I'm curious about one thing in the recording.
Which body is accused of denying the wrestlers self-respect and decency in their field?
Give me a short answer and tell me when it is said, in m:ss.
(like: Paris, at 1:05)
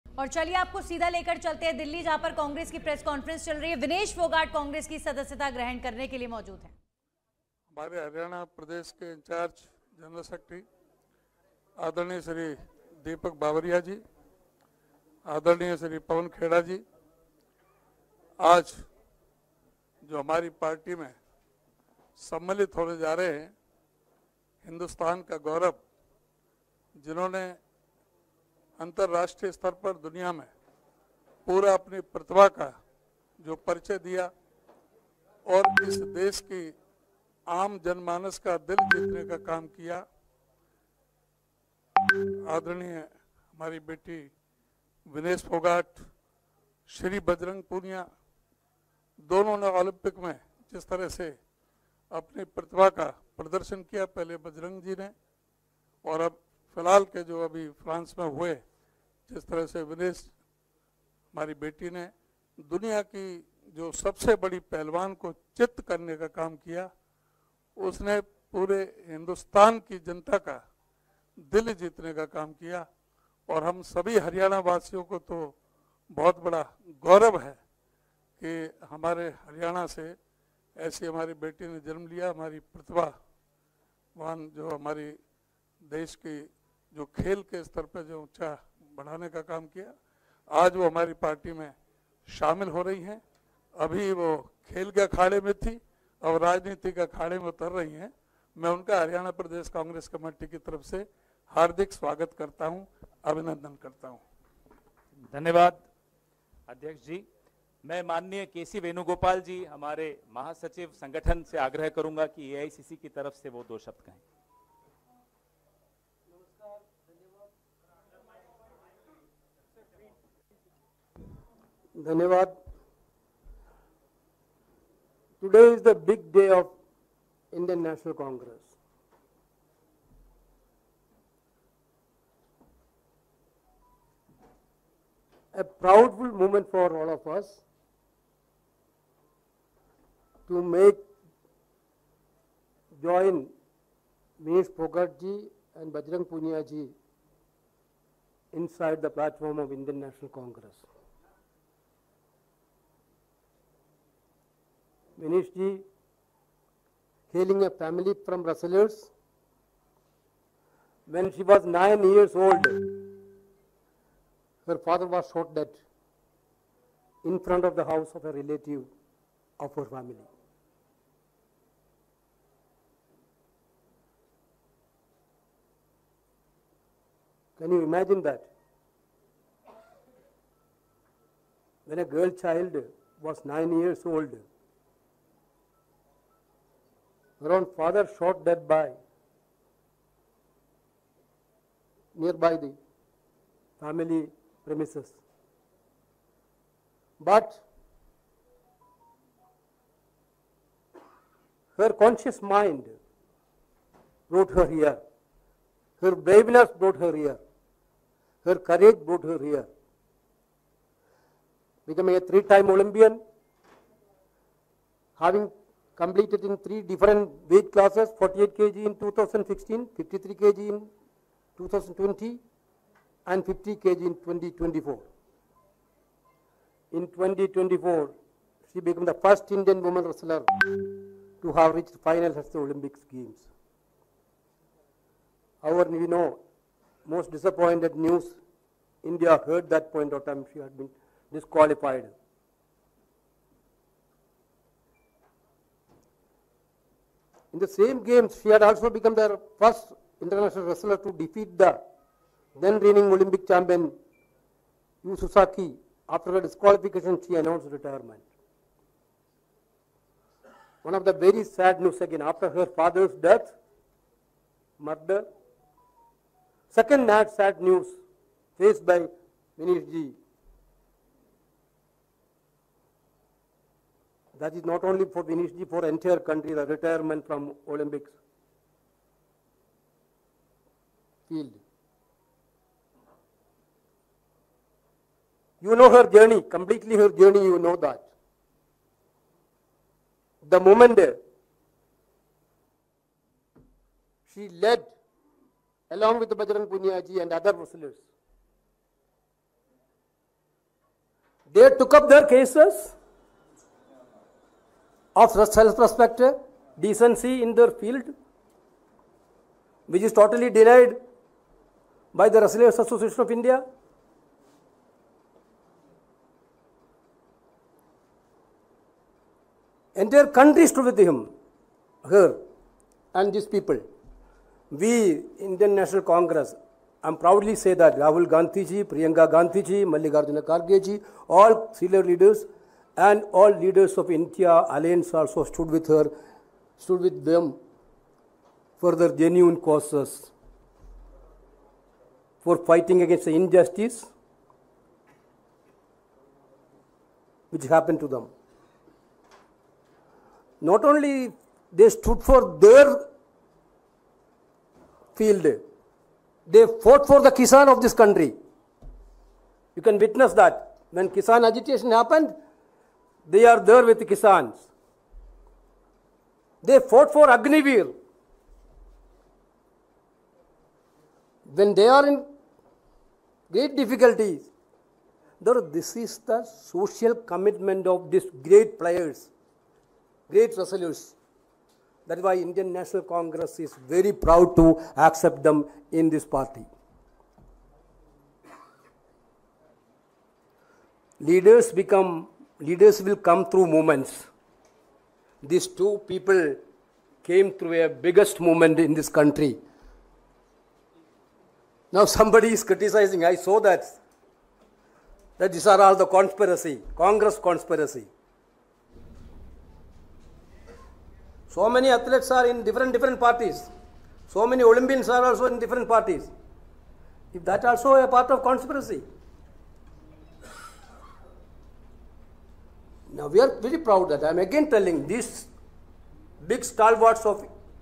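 Wrestlers Association of India, at 5:12.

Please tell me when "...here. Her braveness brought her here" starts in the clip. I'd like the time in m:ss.
3:24.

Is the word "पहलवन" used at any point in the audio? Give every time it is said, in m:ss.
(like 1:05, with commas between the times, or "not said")
1:04.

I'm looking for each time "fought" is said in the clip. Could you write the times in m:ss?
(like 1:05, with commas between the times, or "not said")
5:56, 6:06.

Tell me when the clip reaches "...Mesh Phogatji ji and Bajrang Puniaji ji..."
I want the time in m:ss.
2:24.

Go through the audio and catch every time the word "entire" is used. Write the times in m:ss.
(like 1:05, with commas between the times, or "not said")
4:35, 5:19.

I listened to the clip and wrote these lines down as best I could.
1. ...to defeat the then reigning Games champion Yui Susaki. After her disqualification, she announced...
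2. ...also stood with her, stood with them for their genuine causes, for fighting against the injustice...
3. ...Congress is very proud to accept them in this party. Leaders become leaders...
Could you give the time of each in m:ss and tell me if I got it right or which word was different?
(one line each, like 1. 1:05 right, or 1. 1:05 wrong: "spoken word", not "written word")
1. 4:10 wrong: "Olympic", not "Games"
2. 5:35 right
3. 6:23 right.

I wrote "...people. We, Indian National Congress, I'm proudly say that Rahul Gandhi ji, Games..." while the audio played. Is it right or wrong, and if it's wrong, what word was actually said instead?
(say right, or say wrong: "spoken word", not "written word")
wrong: "Priyanka", not "Games".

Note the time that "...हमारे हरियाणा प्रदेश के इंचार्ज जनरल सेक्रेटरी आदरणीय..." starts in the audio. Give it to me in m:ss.
0:06.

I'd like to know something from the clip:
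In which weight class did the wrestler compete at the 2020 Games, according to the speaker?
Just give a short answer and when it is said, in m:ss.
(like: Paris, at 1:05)
53 kg, at 3:39.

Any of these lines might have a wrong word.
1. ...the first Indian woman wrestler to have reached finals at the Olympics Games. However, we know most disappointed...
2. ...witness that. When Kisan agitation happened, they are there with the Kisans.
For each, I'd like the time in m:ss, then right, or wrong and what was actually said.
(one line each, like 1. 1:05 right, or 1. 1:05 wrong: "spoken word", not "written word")
1. 3:49 right
2. 5:59 right.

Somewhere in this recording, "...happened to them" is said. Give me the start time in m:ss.
5:47.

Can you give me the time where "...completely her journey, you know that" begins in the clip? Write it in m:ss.
4:46.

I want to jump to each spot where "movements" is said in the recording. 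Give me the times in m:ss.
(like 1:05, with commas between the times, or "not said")
6:33, 6:38.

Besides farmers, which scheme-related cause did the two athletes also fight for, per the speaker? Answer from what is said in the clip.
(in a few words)
Agnivir.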